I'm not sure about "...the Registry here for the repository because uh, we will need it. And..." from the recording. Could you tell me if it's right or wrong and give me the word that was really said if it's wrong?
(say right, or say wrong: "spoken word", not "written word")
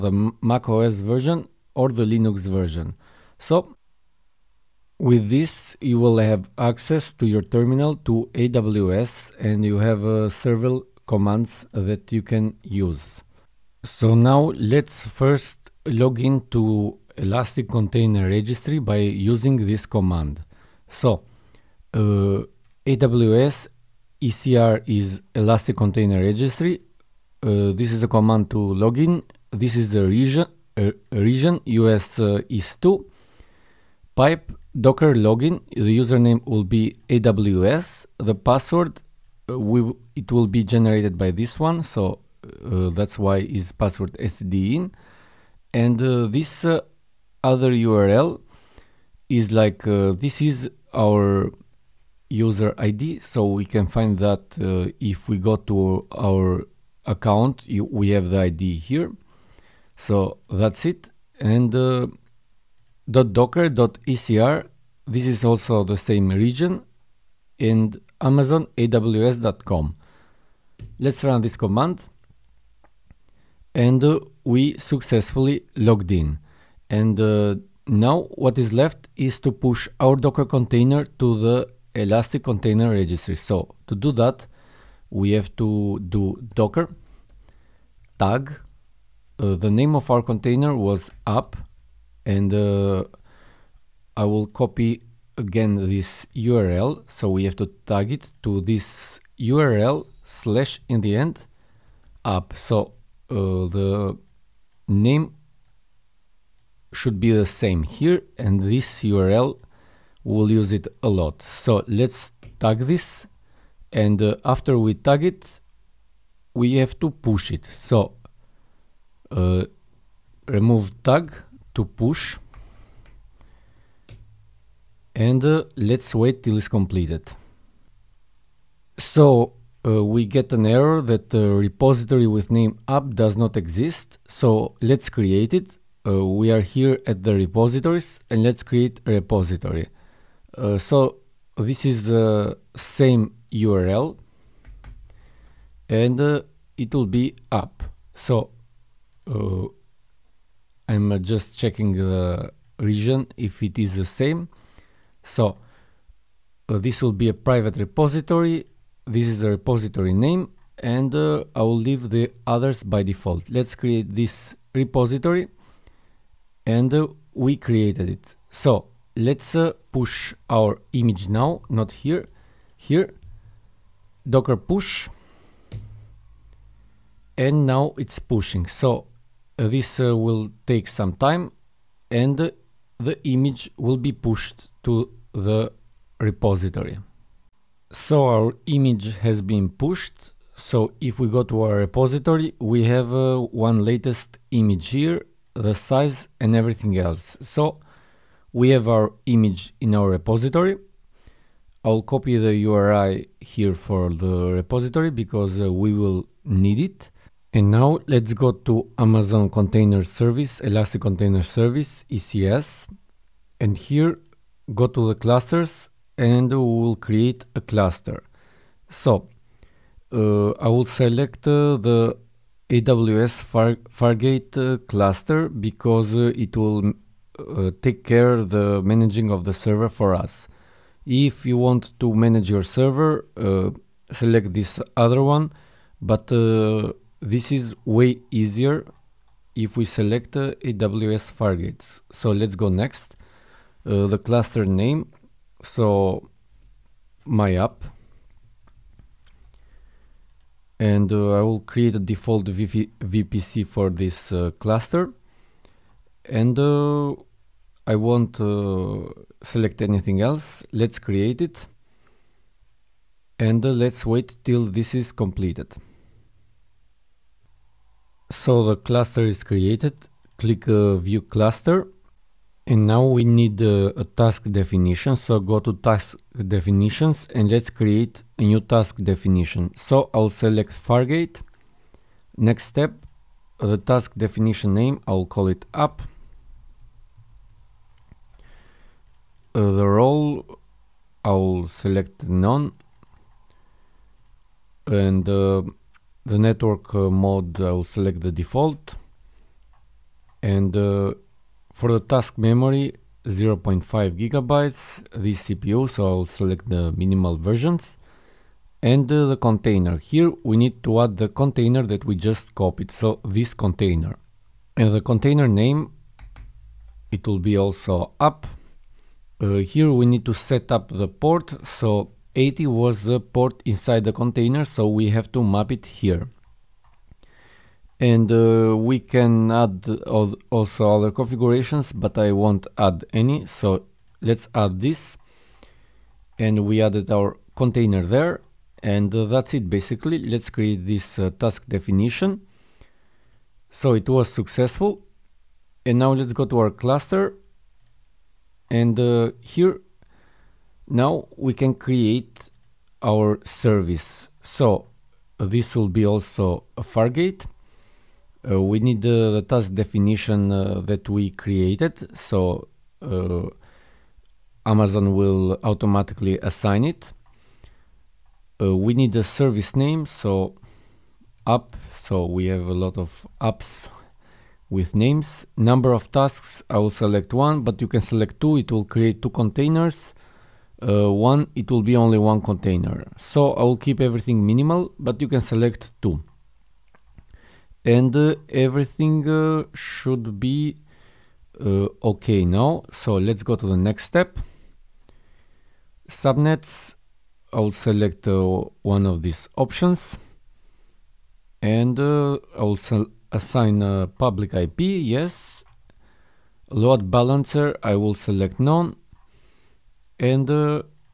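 wrong: "URI", not "Registry".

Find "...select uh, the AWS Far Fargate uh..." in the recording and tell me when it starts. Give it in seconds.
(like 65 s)
220 s.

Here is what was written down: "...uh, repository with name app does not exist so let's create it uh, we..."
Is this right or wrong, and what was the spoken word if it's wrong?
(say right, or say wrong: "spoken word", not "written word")
right.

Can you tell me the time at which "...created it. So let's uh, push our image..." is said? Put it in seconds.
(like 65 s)
167 s.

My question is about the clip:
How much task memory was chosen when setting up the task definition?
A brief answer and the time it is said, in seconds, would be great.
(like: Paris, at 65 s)
0.5 gigabytes, at 303 s.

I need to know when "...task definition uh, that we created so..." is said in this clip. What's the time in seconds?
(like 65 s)
359 s.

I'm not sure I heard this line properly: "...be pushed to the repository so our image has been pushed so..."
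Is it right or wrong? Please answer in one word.
right.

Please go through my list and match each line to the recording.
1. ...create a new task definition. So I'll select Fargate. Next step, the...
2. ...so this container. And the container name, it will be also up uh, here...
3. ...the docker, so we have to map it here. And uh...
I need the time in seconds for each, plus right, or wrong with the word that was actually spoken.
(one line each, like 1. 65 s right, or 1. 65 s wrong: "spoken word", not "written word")
1. 277 s right
2. 312 s right
3. 324 s wrong: "container", not "docker".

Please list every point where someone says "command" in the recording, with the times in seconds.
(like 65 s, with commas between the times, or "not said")
11 s, 19 s, 28 s, 71 s.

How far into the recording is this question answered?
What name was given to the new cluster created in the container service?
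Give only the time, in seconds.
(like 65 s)
247 s.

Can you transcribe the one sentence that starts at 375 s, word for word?
Number of tasks, I will select one, but you can select two.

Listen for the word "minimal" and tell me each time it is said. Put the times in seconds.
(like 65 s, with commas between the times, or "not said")
306 s, 384 s.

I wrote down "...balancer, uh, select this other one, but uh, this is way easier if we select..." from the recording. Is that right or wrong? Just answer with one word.
wrong.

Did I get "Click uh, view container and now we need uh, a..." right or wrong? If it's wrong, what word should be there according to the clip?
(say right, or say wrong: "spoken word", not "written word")
wrong: "cluster", not "container".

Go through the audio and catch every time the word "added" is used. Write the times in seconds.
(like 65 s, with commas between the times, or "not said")
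336 s.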